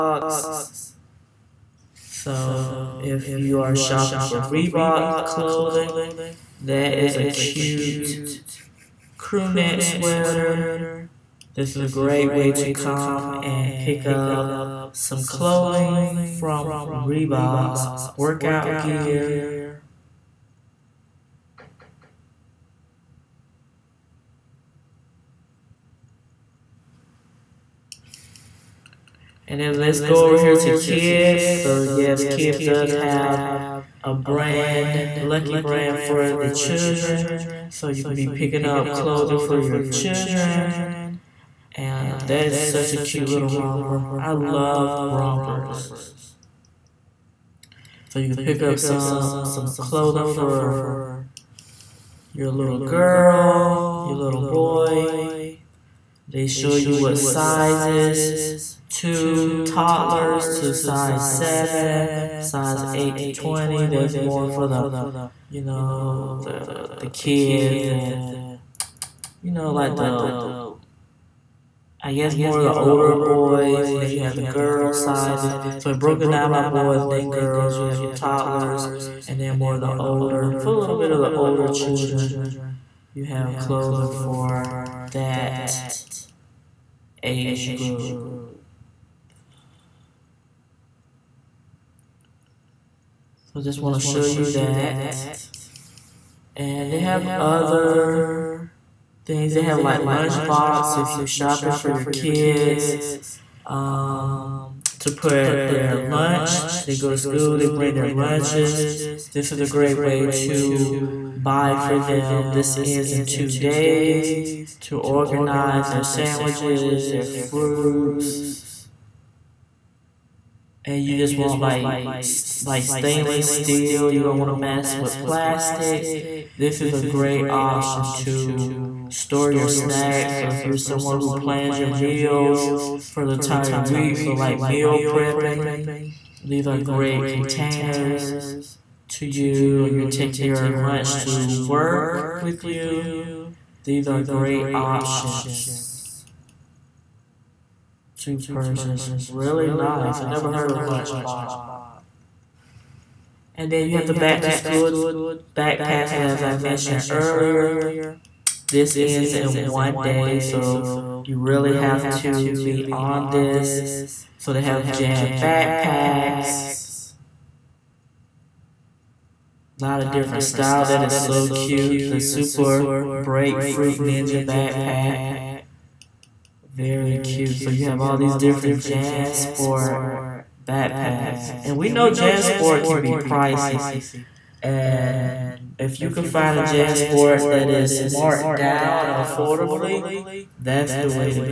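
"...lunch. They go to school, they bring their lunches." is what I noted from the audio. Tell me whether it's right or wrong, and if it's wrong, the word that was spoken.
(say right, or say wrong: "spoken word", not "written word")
right.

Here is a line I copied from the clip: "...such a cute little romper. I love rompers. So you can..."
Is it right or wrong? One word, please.
right.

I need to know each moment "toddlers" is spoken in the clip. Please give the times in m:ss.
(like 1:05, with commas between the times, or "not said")
0:59, 1:18.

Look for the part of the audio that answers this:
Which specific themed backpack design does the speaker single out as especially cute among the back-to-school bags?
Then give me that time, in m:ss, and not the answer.
2:53.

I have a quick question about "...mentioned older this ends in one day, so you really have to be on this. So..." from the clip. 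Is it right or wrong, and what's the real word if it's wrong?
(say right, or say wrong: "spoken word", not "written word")
wrong: "earlier", not "older".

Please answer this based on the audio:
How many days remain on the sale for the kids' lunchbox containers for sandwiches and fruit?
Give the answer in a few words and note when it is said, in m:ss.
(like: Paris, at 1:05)
2, at 1:53.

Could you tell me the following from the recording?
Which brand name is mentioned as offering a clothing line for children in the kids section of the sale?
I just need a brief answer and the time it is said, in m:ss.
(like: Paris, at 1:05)
Lucky Brand, at 0:35.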